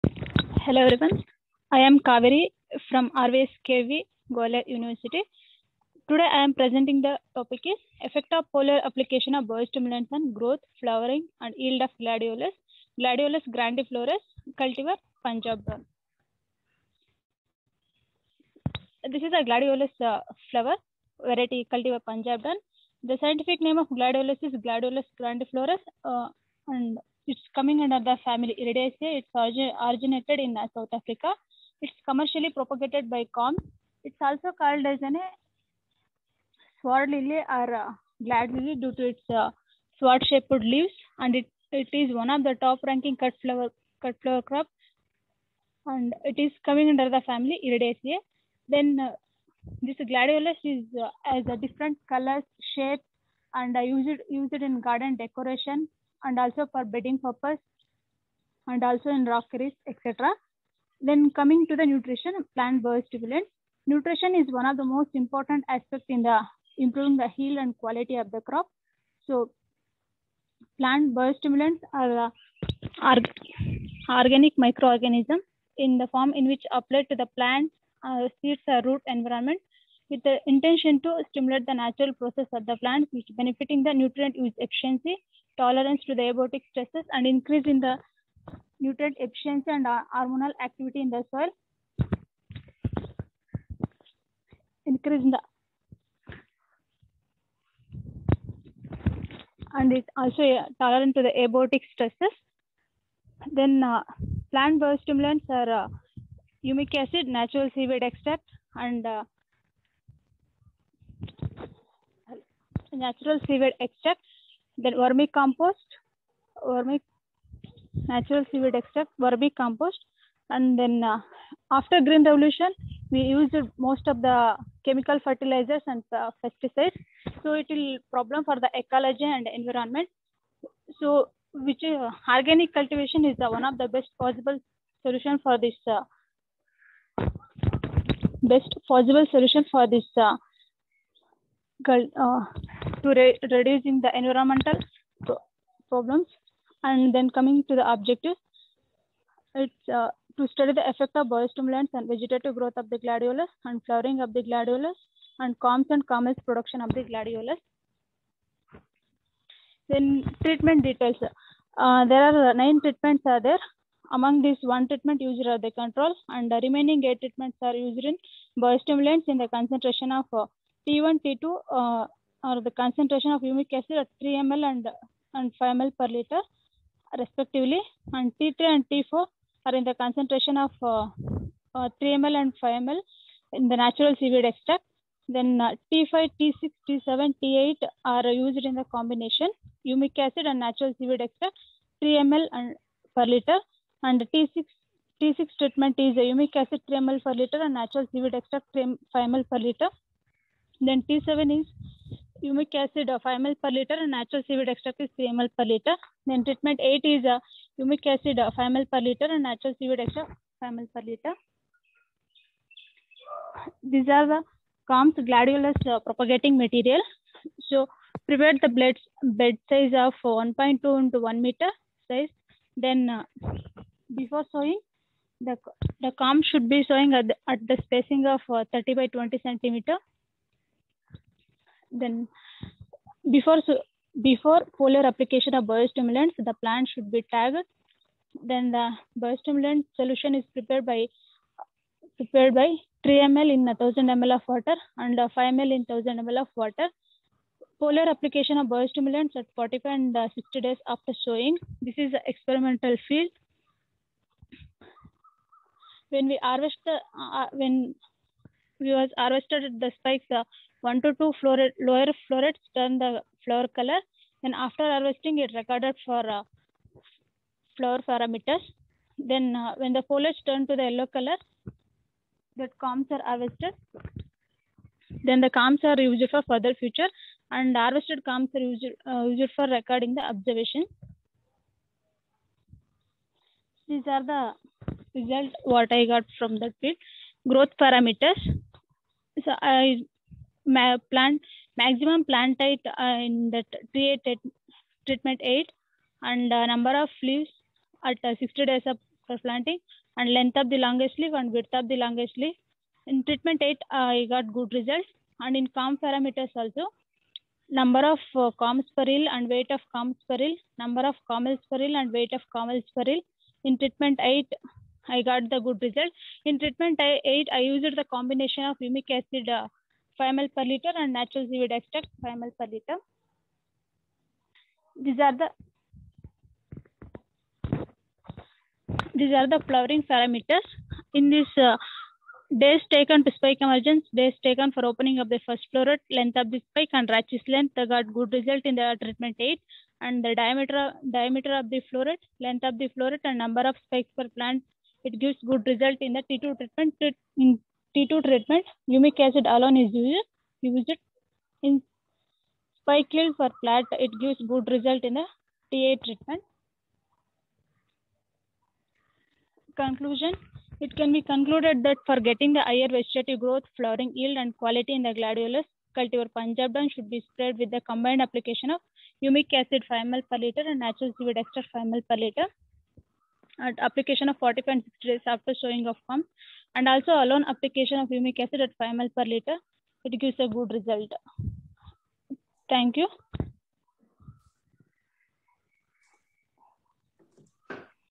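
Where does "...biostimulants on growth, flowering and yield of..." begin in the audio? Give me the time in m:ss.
0:09.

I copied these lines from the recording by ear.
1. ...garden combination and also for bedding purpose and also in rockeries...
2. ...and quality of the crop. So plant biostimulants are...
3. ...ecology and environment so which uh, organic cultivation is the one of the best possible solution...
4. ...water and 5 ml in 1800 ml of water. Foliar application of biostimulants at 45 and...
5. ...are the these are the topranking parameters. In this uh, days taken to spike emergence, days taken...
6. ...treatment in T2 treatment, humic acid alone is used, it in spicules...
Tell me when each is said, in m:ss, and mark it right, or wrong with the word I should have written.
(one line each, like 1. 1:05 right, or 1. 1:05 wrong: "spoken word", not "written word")
1. 0:54 wrong: "decoration", not "combination"
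2. 1:07 right
3. 2:08 right
4. 4:04 wrong: "1000", not "1800"
5. 5:25 wrong: "flowering", not "topranking"
6. 5:46 right.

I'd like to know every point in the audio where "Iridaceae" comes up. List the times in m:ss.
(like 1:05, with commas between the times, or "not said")
0:28, 0:47.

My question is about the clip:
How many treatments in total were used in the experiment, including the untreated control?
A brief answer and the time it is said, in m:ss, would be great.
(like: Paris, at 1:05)
9, at 2:42.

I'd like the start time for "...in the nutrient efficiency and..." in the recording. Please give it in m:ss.
1:27.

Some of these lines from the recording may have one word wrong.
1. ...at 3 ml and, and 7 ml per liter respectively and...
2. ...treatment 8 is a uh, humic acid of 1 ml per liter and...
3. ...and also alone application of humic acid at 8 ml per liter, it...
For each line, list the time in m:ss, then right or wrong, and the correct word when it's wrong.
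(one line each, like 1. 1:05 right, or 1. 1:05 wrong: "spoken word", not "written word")
1. 2:53 wrong: "5", not "7"
2. 3:26 wrong: "5", not "1"
3. 6:16 wrong: "5", not "8".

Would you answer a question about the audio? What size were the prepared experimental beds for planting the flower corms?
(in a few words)
1.2 x 1 meter.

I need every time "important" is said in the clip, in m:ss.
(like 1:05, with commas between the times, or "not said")
1:05.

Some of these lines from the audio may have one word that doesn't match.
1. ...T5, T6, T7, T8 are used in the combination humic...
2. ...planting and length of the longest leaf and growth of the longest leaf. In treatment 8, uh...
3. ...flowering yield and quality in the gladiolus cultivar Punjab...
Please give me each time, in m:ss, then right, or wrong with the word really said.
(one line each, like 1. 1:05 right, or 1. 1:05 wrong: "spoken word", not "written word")
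1. 3:05 right
2. 4:59 wrong: "width", not "growth"
3. 6:03 right.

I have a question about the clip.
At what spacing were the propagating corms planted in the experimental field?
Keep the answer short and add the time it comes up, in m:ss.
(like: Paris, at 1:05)
30 by 20 cm, at 3:48.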